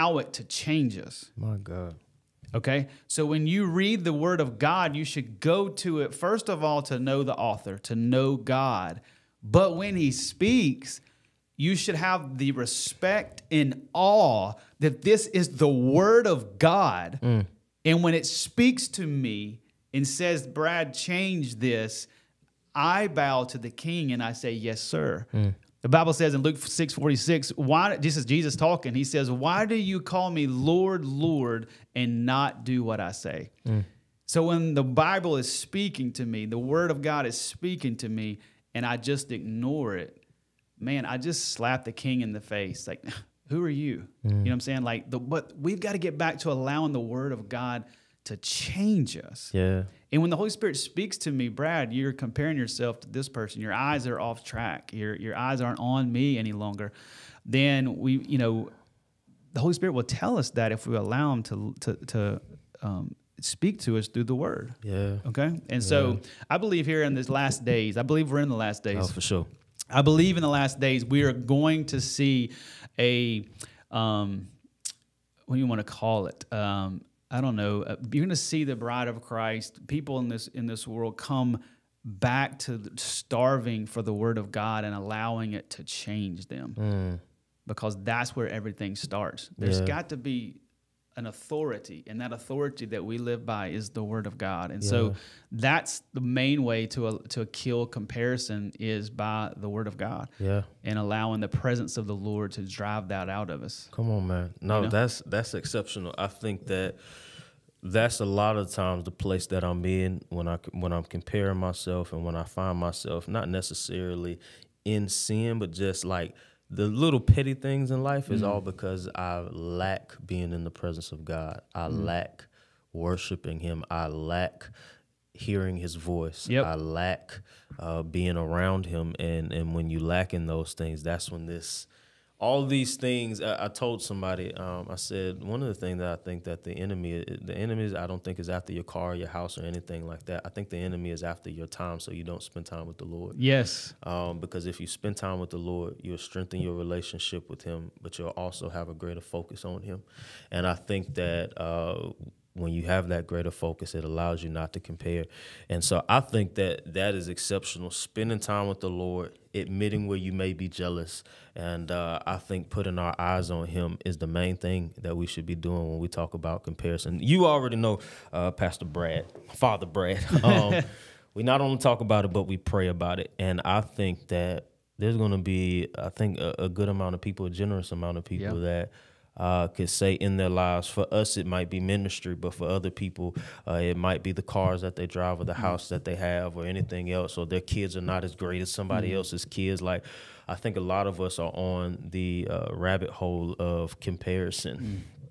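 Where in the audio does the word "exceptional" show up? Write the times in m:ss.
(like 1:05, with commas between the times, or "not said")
1:45, 2:37.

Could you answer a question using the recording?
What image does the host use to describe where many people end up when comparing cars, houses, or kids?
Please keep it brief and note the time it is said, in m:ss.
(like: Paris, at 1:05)
Rabbit hole, at 3:12.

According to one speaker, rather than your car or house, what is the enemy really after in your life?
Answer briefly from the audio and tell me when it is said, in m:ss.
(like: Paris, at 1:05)
Your time, at 2:21.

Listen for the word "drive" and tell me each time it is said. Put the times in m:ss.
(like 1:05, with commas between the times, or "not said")
1:42, 3:05.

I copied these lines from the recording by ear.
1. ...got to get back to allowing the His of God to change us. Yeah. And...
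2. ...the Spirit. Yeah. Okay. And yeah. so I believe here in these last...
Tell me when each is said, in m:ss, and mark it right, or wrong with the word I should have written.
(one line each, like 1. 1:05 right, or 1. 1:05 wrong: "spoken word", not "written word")
1. 0:45 wrong: "Word", not "His"
2. 1:04 wrong: "Word", not "Spirit".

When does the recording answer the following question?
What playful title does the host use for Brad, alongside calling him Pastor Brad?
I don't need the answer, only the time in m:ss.
2:49.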